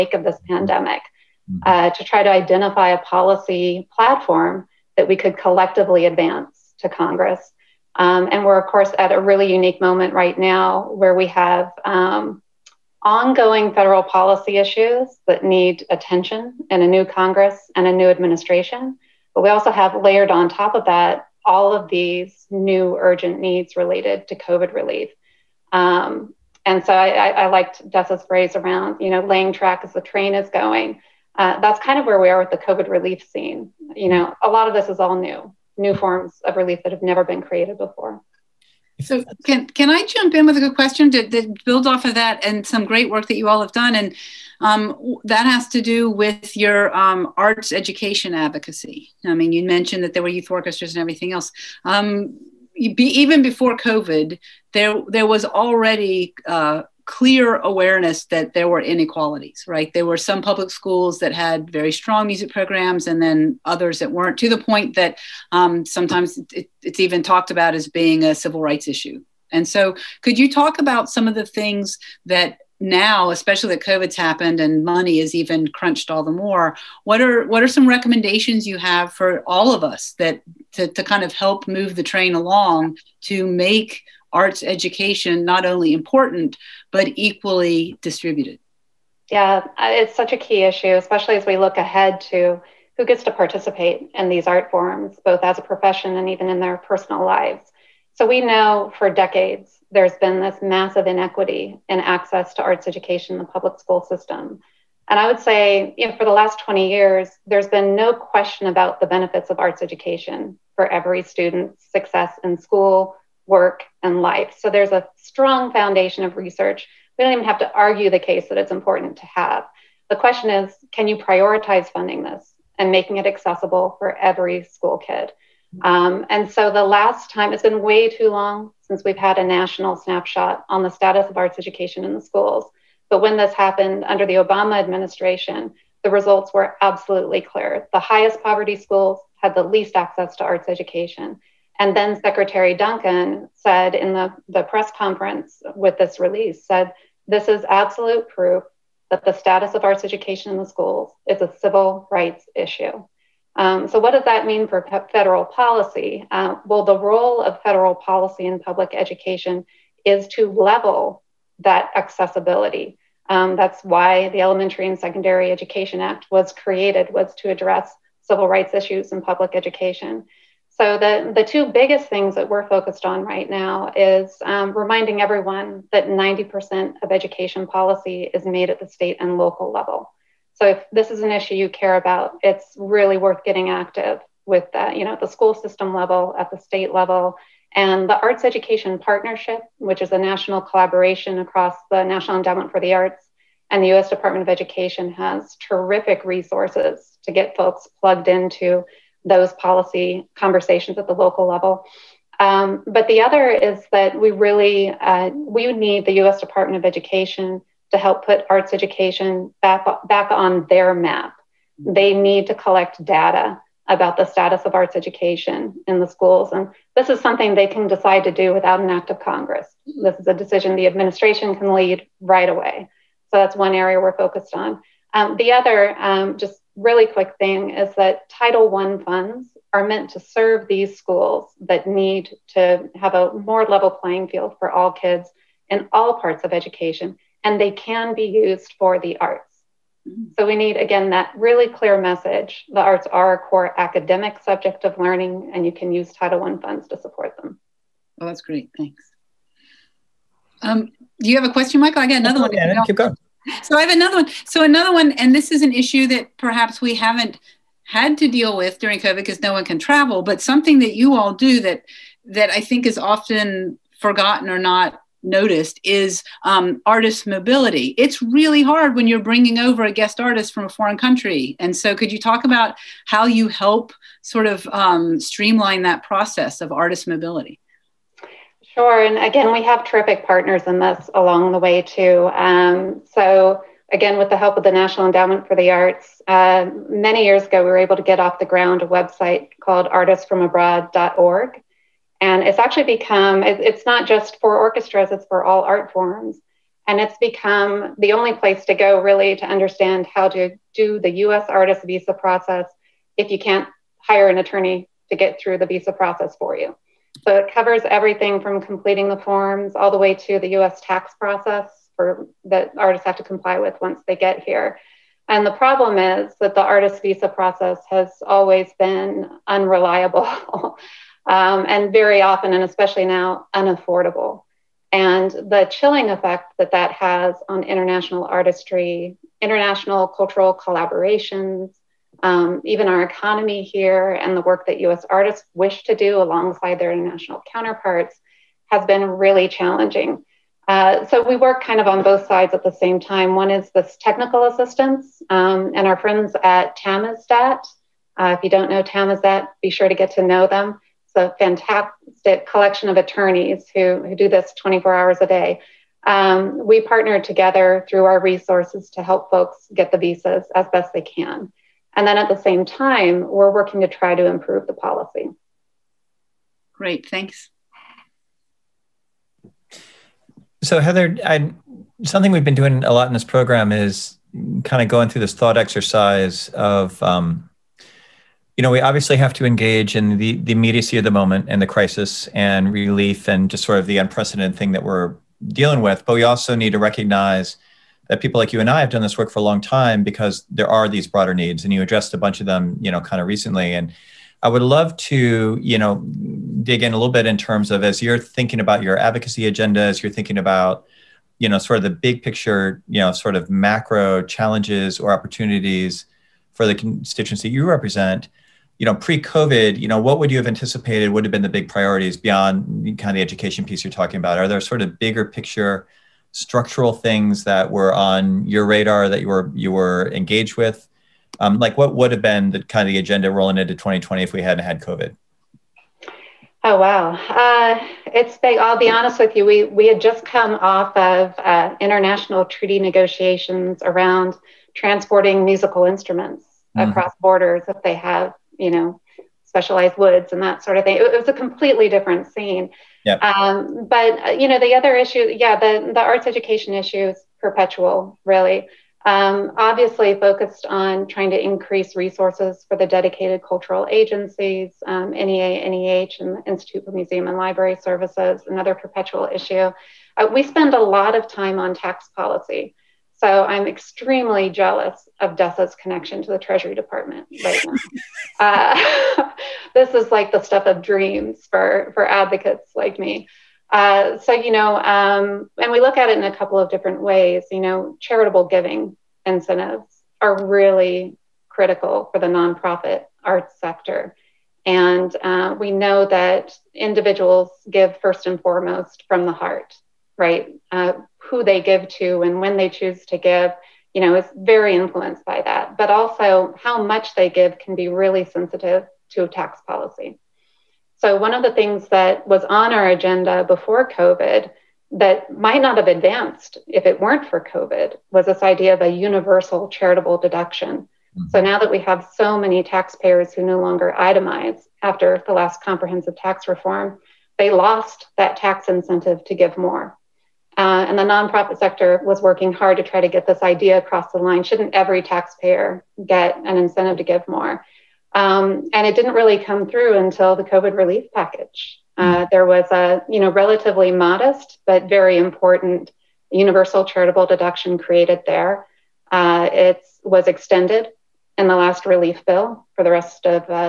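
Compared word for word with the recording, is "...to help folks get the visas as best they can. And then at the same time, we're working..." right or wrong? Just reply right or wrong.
right.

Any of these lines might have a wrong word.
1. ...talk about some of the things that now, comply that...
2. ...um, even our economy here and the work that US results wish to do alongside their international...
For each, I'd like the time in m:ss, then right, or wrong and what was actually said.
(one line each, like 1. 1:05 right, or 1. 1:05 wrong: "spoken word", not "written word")
1. 1:10 wrong: "especially", not "comply"
2. 5:32 wrong: "artists", not "results".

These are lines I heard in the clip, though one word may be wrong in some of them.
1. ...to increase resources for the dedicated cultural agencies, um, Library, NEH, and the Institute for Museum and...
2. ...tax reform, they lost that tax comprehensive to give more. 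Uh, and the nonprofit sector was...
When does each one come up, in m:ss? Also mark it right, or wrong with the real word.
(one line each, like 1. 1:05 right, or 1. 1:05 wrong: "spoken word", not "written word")
1. 7:31 wrong: "NEA", not "Library"
2. 8:36 wrong: "incentive", not "comprehensive".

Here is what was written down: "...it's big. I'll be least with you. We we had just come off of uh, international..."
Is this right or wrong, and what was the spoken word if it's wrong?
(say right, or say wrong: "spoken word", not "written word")
wrong: "honest", not "least".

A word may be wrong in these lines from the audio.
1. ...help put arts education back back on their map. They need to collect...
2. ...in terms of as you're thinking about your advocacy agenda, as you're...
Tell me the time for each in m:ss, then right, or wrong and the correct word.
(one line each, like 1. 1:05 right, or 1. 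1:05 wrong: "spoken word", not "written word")
1. 3:27 right
2. 6:37 right.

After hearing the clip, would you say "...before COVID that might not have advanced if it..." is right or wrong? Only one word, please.
right.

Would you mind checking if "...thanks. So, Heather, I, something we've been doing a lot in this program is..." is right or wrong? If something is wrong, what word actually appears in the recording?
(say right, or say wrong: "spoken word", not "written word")
right.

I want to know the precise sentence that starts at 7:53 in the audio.
Uh, so, you know, um, and we look at it in a couple of different ways.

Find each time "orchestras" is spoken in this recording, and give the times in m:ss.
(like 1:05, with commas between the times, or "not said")
0:50, 4:54.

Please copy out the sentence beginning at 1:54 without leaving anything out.
So there's a strong foundation of research.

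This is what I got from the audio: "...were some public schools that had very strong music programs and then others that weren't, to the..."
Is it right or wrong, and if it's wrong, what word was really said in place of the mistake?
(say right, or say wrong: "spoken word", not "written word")
right.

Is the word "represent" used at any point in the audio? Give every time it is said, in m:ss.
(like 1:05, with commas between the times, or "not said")
6:47.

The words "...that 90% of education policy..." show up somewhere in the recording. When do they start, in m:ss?
2:55.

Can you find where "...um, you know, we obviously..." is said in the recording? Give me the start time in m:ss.
6:17.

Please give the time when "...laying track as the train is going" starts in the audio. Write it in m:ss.
0:29.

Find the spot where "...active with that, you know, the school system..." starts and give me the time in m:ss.
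3:03.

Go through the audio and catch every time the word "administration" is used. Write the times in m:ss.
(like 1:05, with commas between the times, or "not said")
0:18, 2:14, 3:40.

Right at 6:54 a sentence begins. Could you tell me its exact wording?
Are there sort of bigger picture structural things that were on your radar that you were you were engaged with?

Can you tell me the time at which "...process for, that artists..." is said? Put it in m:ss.
5:11.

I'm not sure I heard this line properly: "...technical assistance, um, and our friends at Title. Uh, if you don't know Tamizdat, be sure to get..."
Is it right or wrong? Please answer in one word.
wrong.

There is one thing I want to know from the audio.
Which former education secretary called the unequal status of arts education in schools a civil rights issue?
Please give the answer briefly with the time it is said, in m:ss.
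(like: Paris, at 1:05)
Secretary Duncan, at 2:22.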